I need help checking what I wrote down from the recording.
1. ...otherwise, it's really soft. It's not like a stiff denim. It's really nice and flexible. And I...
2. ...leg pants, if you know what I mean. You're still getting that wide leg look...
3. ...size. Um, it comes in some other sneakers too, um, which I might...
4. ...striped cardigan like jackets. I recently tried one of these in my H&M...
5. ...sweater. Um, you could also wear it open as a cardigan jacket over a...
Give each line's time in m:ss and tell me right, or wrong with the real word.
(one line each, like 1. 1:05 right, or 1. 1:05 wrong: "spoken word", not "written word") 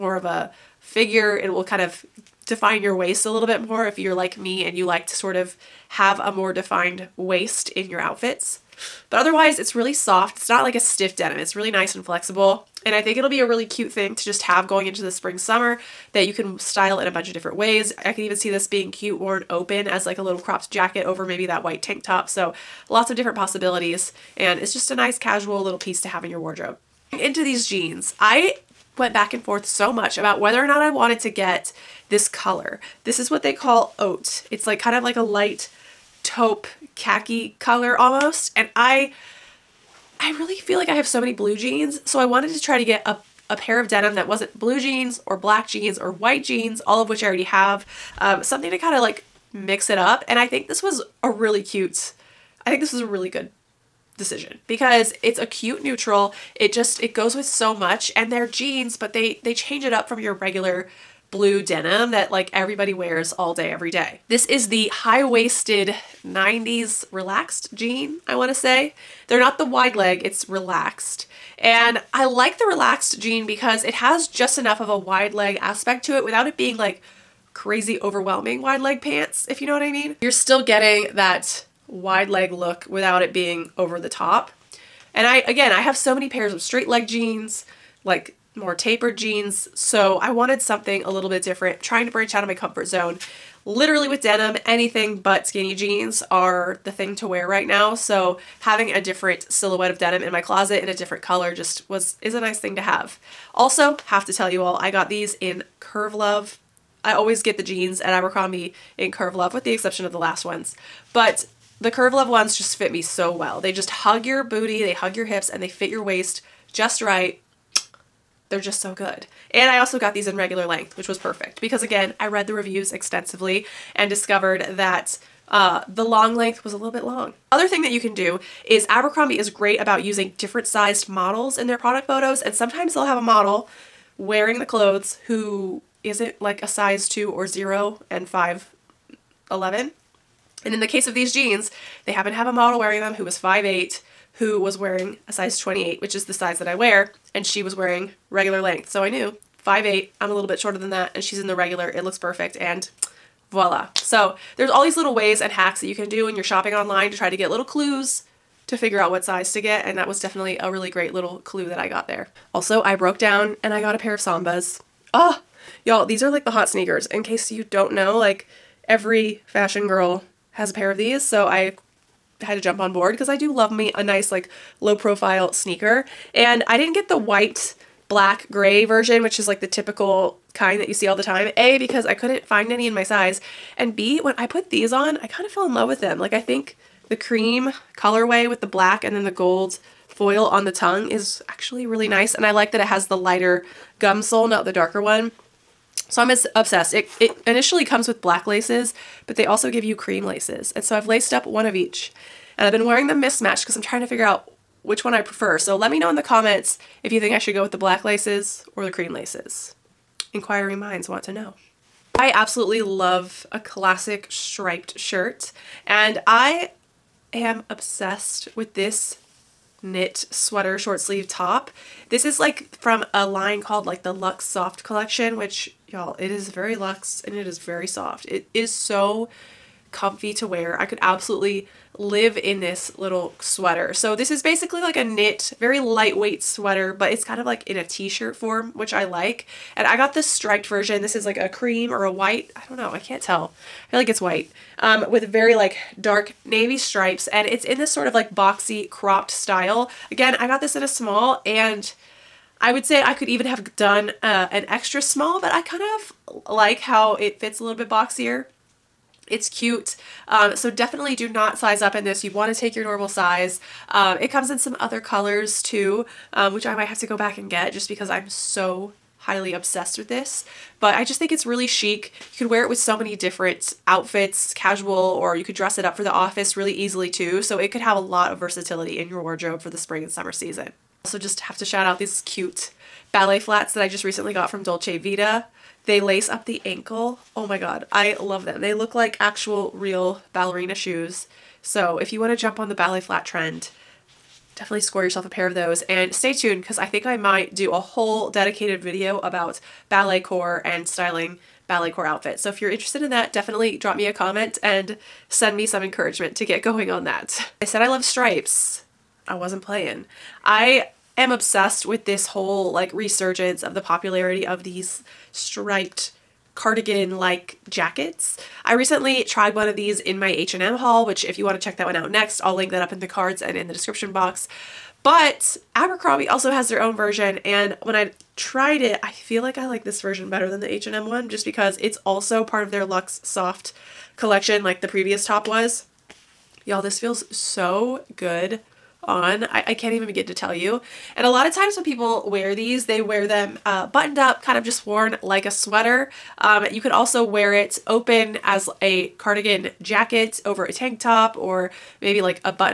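1. 0:09 right
2. 1:18 right
3. 4:23 wrong: "colors", not "sneakers"
4. 5:15 right
5. 5:45 right.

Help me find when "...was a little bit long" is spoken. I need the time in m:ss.
2:06.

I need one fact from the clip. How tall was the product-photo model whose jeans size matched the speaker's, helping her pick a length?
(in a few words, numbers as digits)
5'8.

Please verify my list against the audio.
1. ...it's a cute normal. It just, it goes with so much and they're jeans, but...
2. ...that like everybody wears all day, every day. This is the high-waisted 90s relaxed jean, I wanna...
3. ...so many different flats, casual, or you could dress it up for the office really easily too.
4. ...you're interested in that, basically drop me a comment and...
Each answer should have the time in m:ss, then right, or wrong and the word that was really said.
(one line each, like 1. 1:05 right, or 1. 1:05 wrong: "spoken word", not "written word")
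1. 0:55 wrong: "neutral", not "normal"
2. 1:02 right
3. 4:32 wrong: "outfits", not "flats"
4. 5:02 wrong: "definitely", not "basically".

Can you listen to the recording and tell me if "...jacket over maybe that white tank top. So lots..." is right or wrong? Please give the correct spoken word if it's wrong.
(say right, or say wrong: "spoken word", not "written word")
right.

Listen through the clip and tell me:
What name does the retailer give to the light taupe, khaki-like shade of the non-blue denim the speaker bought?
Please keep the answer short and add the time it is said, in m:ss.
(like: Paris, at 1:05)
Oat, at 0:33.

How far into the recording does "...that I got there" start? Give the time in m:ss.
2:41.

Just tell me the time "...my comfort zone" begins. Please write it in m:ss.
1:32.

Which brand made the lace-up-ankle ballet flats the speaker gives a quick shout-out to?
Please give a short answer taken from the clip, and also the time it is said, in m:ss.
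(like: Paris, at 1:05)
Dolce Vita, at 4:44.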